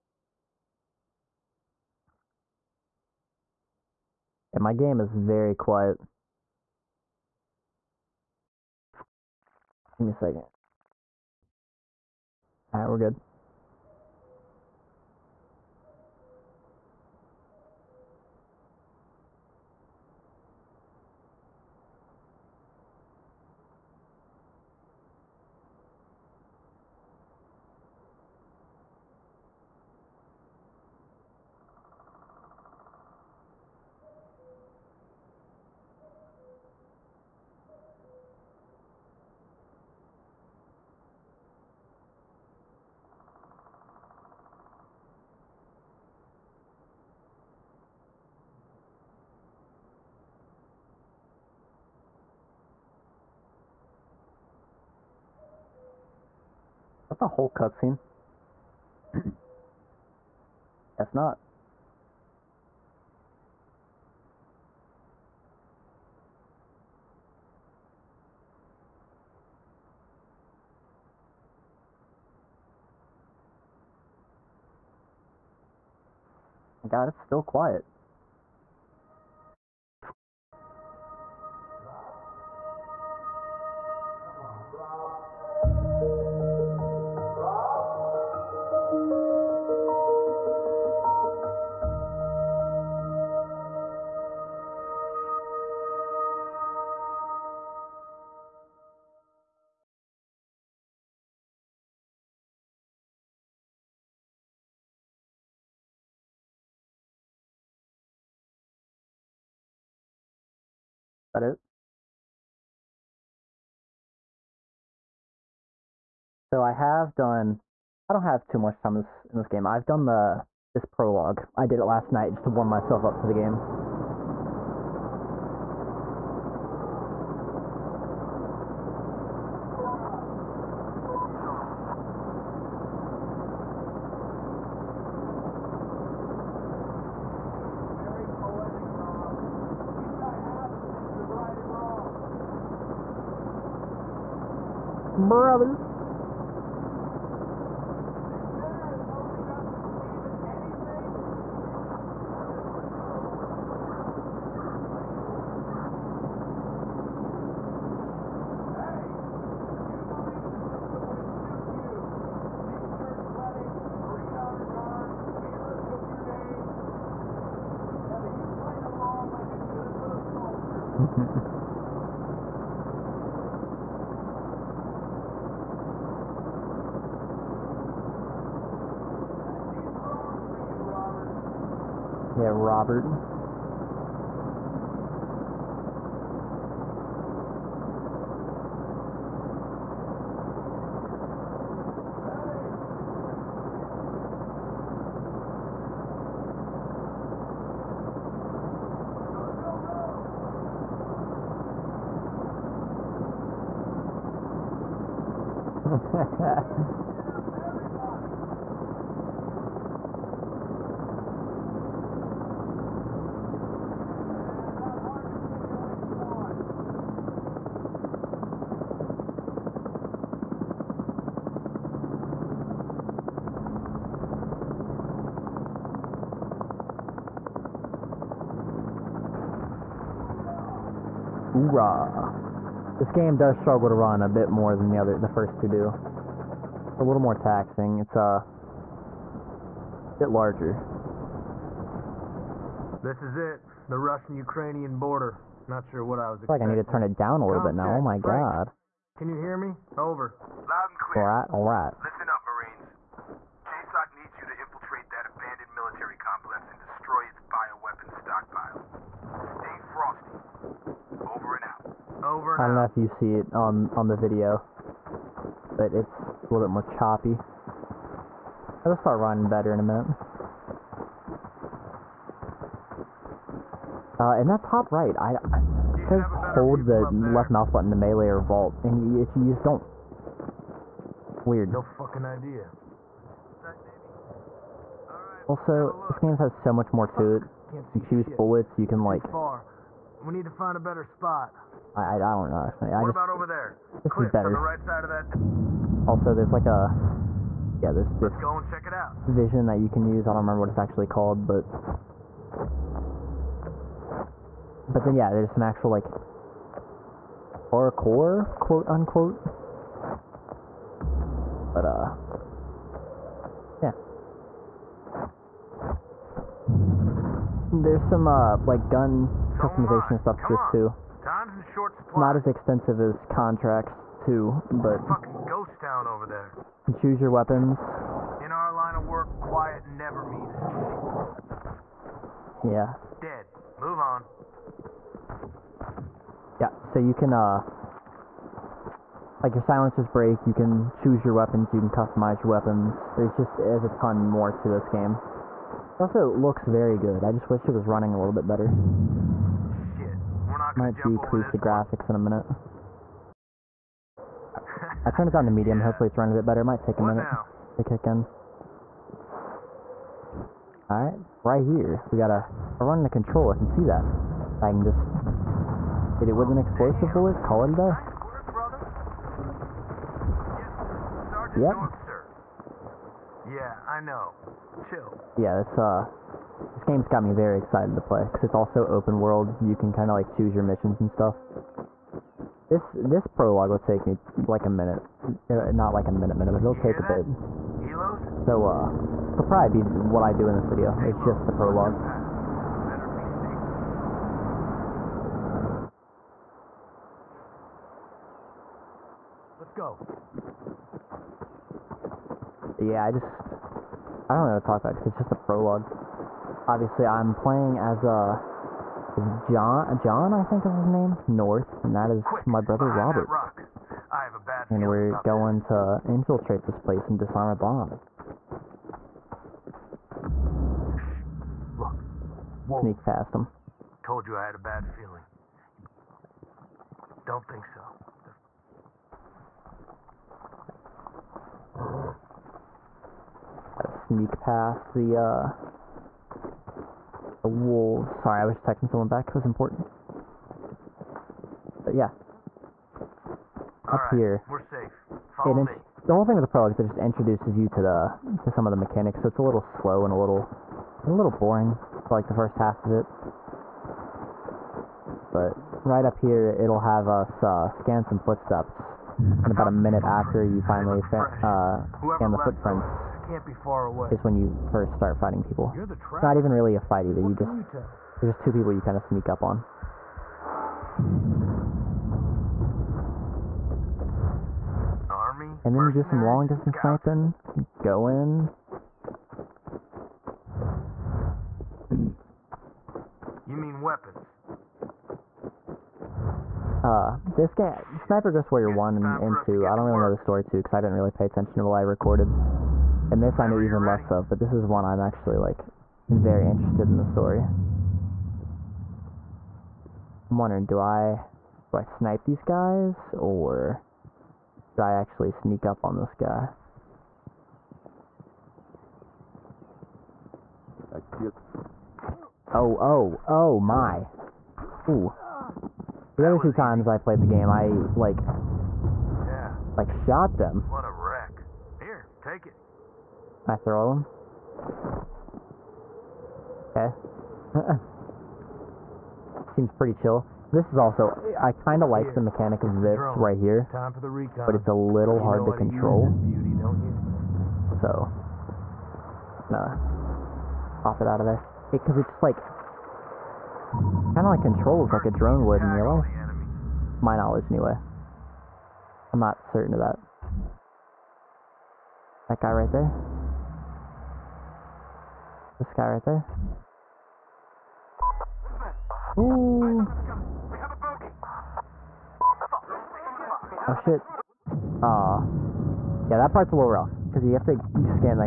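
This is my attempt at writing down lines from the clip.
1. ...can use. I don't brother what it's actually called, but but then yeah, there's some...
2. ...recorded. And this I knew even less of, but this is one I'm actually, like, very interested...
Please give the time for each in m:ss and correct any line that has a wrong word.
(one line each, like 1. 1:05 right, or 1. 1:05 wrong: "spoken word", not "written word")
1. 4:59 wrong: "remember", not "brother"
2. 8:11 right.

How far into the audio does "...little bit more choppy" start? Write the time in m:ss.
4:26.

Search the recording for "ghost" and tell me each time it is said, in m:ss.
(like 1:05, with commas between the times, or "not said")
5:25, 8:08.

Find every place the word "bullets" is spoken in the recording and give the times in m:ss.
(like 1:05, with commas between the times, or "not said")
4:48, 6:07.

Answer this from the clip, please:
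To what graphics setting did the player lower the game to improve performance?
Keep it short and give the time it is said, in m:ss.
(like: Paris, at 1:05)
Medium, at 5:55.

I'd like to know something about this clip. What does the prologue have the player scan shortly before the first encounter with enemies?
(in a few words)
Footprints.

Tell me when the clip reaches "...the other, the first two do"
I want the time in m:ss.
3:54.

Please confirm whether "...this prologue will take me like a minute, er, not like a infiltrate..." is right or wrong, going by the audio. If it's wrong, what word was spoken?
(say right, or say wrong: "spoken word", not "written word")
wrong: "minute", not "infiltrate".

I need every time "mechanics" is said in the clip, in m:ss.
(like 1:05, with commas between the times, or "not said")
7:28, 8:52.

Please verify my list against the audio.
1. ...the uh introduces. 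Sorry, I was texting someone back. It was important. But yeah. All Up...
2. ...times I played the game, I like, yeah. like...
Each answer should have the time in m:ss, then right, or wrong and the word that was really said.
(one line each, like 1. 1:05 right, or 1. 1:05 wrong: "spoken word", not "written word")
1. 7:14 wrong: "wolves", not "introduces"
2. 8:36 right.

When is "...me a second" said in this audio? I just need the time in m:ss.
0:10.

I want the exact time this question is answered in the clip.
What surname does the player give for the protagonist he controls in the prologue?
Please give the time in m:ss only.
6:51.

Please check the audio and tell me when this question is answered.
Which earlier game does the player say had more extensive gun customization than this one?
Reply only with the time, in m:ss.
5:23.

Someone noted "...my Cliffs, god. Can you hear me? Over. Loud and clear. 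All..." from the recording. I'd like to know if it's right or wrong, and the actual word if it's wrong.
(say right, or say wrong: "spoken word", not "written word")
wrong: "Frank", not "Cliffs".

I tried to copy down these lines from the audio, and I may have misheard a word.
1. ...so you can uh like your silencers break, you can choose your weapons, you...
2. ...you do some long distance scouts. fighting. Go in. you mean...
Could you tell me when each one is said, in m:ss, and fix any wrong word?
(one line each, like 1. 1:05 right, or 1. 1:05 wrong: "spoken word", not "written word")
1. 5:36 right
2. 7:55 wrong: "sniping", not "fighting".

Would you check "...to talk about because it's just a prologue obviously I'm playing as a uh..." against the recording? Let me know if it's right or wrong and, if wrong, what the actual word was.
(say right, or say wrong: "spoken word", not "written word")
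right.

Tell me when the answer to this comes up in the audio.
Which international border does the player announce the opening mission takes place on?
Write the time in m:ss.
4:03.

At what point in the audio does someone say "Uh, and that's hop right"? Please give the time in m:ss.
4:34.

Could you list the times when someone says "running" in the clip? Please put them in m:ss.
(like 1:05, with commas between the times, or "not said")
4:29, 5:47, 5:56.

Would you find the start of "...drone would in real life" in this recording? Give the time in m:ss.
9:05.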